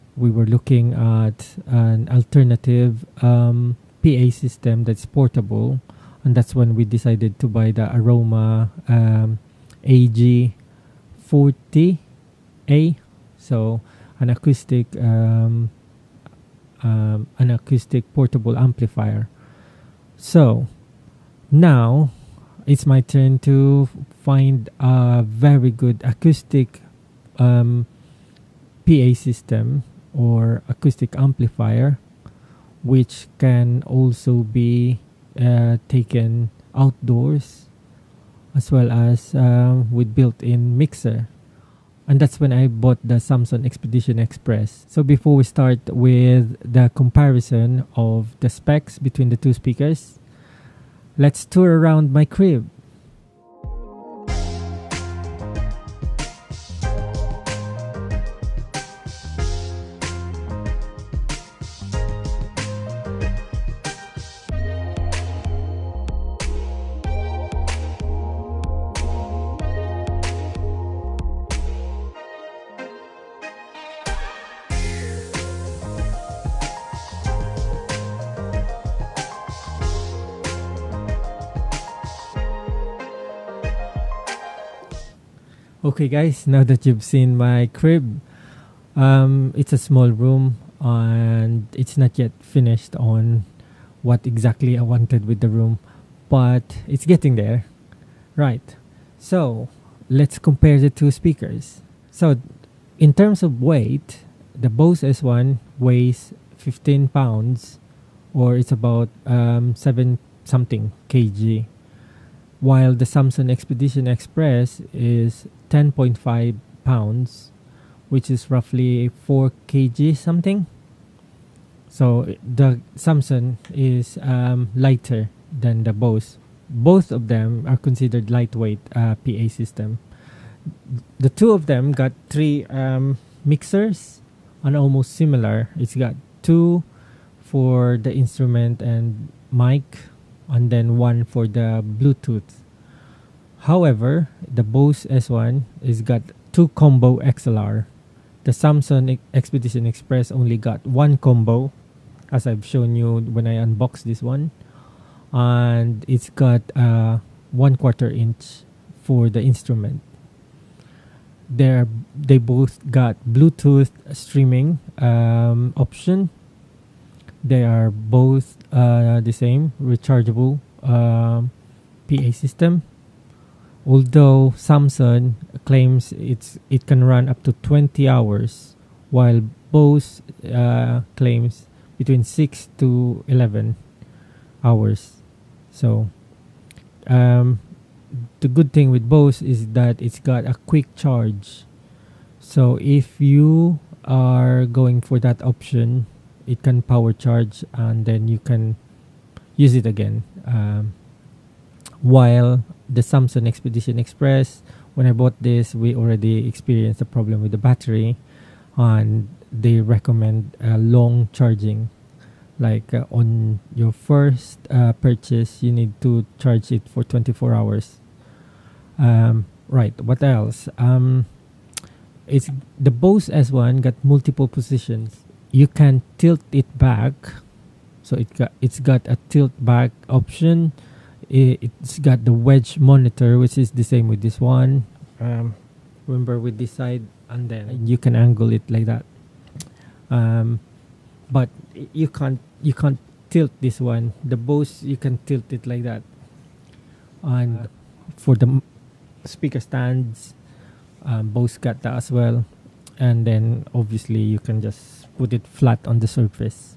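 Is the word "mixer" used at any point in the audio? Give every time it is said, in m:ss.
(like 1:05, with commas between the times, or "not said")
0:40, 2:13.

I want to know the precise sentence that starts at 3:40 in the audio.
Um, it's the Bose S1 got multiple positions.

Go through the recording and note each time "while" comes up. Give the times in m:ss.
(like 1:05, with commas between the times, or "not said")
1:52, 2:59, 3:22.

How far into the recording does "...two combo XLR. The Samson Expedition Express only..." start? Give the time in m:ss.
2:26.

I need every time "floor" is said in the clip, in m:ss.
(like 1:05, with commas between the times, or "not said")
not said.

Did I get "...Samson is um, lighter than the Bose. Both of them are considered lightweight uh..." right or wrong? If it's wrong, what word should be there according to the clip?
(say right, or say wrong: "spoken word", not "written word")
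right.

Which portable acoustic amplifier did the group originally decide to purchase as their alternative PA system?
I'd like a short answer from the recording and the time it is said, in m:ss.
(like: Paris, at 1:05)
Aroma AG40A, at 0:07.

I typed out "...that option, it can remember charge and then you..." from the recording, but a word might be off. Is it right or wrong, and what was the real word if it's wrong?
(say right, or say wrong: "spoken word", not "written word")
wrong: "power", not "remember".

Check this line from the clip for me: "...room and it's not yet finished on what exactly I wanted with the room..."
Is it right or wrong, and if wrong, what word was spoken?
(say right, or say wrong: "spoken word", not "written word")
right.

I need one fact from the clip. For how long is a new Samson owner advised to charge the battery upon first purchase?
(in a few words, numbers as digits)
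24 hours.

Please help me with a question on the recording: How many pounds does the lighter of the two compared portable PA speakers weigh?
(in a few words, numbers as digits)
10.5 pounds.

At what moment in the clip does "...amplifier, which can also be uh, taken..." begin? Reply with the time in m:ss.
0:31.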